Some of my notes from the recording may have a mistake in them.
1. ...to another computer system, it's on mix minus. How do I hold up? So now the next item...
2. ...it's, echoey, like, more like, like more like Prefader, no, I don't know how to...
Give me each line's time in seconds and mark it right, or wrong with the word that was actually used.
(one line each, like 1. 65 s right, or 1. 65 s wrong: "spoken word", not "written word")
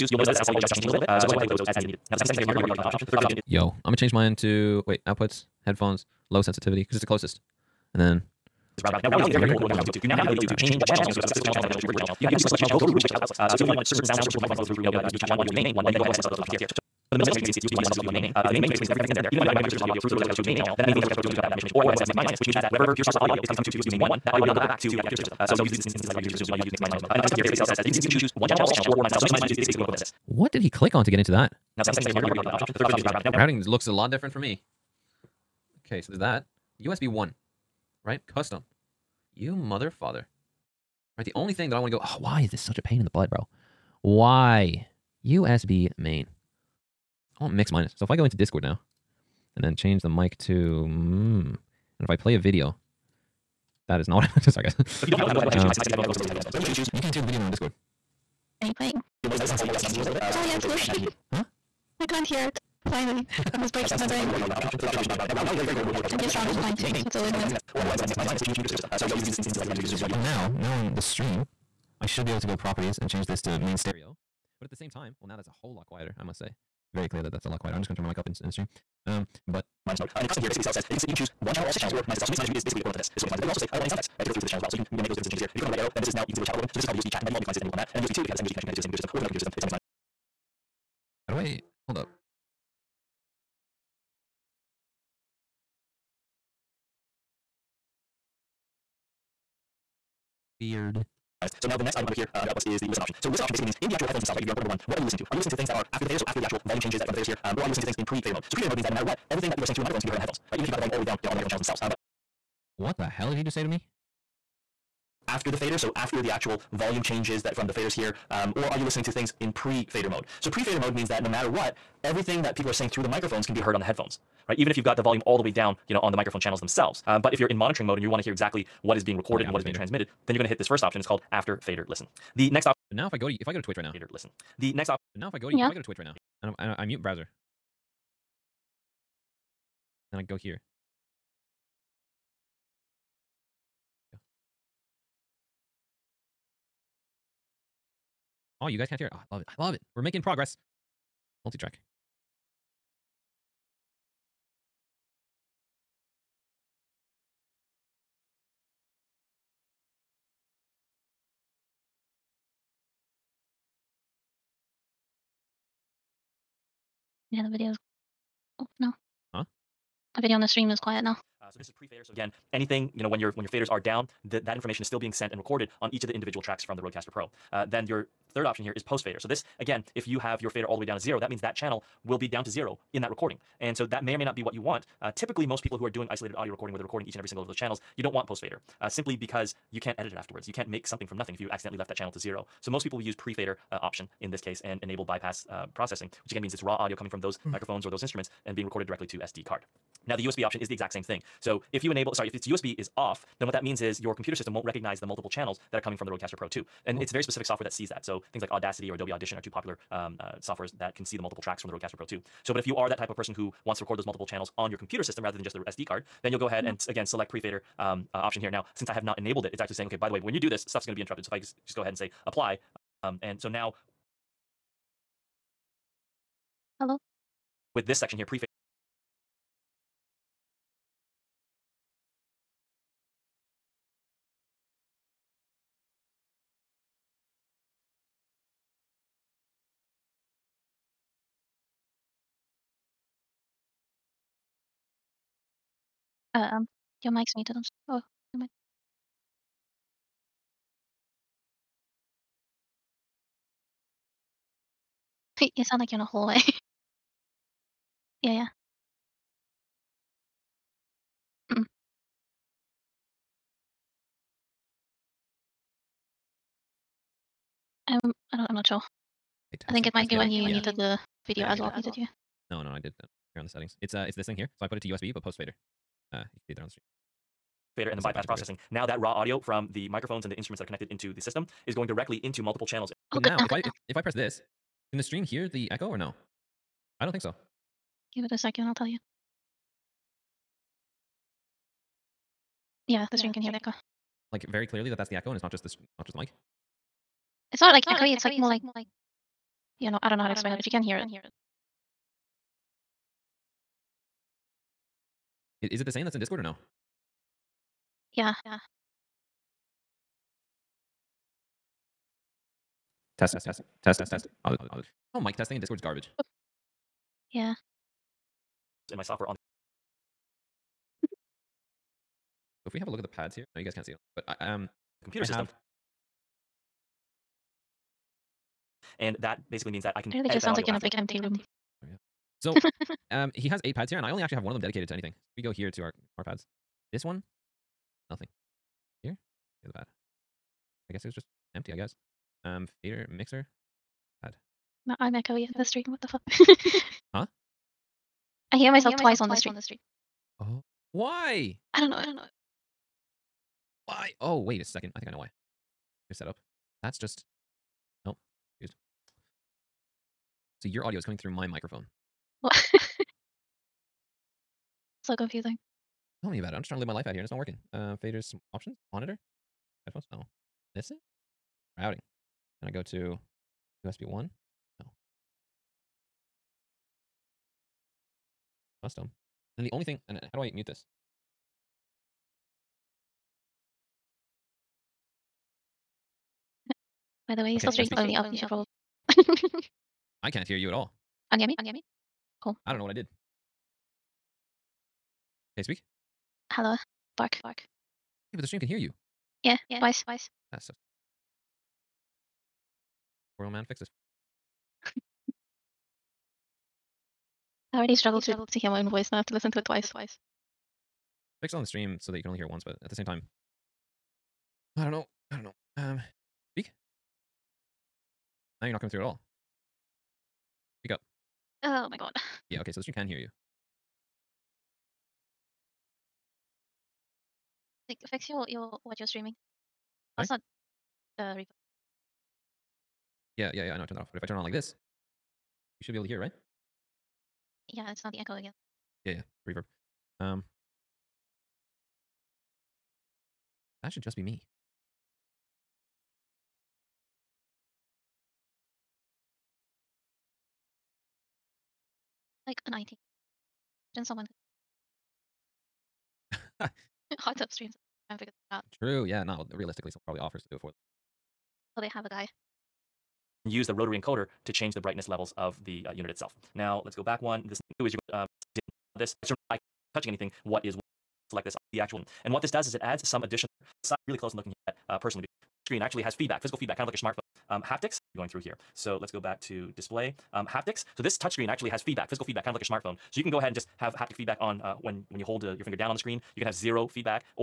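1. 89 s right
2. 298 s wrong: "Yeah", not "Prefader".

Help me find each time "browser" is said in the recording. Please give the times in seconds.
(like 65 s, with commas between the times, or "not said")
137 s.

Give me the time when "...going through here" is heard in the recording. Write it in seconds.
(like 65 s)
478 s.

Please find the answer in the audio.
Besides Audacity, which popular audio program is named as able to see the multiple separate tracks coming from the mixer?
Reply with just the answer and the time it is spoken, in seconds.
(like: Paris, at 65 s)
Adobe Audition, at 208 s.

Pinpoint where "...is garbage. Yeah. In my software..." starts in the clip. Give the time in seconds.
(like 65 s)
315 s.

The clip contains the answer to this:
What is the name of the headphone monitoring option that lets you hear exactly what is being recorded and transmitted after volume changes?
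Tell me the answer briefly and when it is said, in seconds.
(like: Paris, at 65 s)
after fader listen, at 131 s.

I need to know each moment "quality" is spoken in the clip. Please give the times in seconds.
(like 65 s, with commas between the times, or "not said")
0 s, 59 s.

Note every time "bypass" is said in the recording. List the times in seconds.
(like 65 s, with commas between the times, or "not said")
195 s, 278 s.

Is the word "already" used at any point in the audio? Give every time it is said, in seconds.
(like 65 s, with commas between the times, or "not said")
2 s, 32 s, 407 s.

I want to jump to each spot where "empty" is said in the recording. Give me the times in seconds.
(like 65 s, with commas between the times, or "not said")
330 s, 341 s.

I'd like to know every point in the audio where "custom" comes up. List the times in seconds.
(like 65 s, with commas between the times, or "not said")
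27 s, 38 s, 80 s, 378 s.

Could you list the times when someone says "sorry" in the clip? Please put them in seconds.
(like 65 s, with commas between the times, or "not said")
54 s, 202 s, 430 s.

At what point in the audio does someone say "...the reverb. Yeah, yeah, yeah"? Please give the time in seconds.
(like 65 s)
431 s.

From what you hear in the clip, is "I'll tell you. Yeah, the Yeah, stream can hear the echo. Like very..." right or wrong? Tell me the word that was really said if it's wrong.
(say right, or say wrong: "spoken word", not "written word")
right.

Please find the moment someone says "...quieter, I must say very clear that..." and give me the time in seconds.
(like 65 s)
75 s.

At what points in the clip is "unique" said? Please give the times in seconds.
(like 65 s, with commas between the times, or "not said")
not said.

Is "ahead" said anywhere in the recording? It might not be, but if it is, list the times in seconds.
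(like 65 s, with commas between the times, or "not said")
1 s, 16 s, 21 s, 55 s, 67 s, 216 s, 221 s, 483 s.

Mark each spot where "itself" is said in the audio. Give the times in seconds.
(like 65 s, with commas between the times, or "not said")
82 s, 466 s.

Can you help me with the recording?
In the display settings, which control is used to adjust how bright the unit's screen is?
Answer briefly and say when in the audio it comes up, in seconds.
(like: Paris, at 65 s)
rotary encoder, at 463 s.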